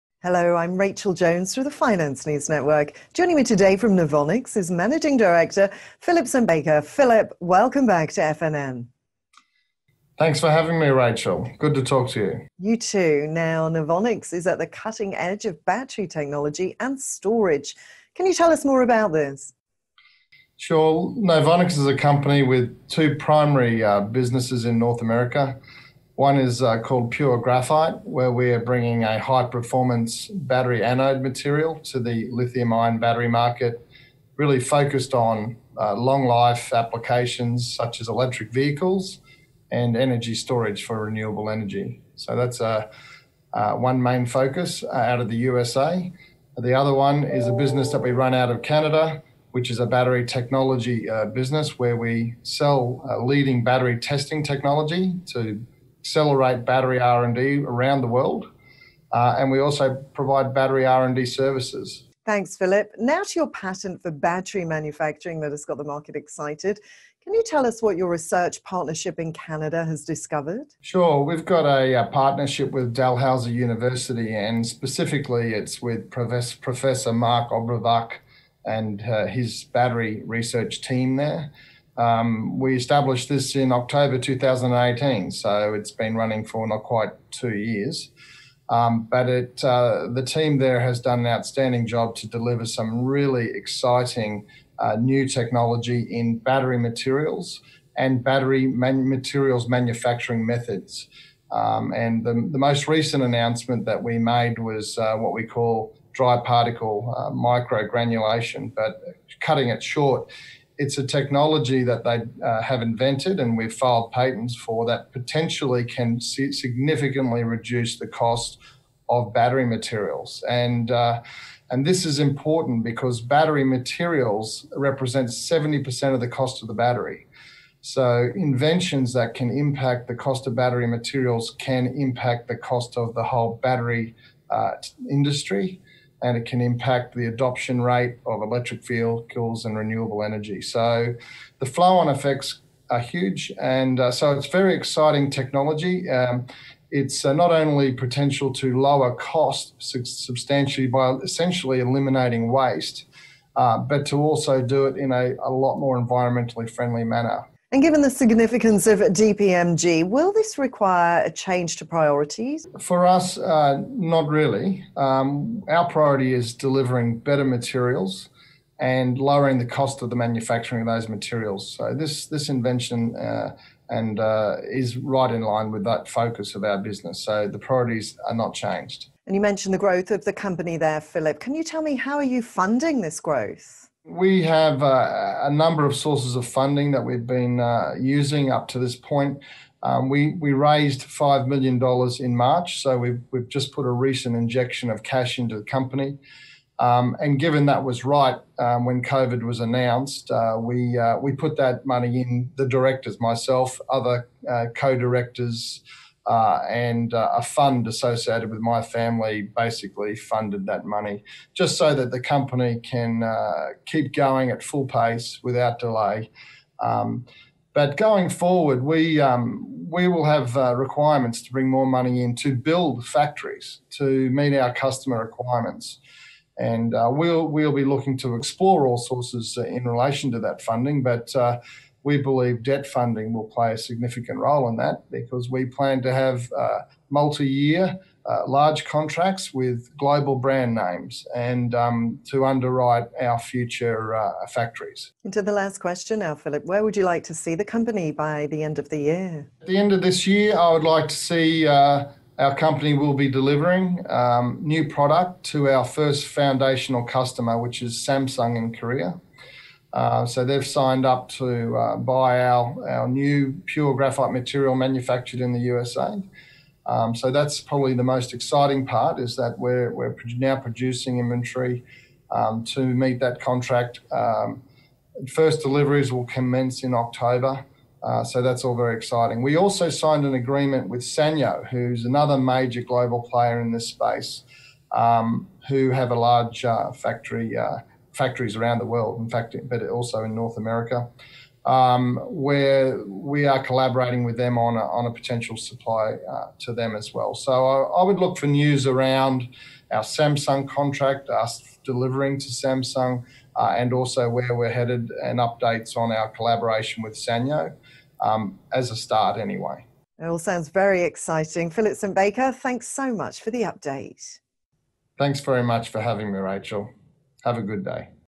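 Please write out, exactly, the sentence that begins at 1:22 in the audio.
Um, we established this in October 2018, so it's been running for not quite two years.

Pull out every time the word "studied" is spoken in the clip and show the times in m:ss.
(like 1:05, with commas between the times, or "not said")
not said.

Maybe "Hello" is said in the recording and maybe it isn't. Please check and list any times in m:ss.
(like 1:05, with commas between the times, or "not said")
0:00.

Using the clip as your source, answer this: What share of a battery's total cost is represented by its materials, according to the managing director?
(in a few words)
70%.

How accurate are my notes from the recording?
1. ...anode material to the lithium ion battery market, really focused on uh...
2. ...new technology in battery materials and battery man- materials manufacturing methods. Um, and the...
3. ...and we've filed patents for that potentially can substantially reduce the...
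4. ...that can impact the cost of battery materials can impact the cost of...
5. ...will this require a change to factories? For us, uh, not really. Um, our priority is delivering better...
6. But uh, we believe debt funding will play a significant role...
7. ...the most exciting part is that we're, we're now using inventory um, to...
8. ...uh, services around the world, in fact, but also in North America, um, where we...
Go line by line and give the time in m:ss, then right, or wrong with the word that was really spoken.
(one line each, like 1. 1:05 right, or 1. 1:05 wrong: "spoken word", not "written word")
1. 0:30 right
2. 1:34 right
3. 1:53 wrong: "significantly", not "substantially"
4. 2:09 right
5. 2:40 wrong: "priorities", not "factories"
6. 3:51 right
7. 4:27 wrong: "producing", not "using"
8. 4:47 wrong: "factories", not "services".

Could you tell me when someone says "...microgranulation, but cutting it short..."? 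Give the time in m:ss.
1:47.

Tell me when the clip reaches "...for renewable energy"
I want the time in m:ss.
0:40.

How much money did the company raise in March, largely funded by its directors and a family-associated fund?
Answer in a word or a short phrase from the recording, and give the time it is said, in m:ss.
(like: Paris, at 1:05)
$5 million, at 3:11.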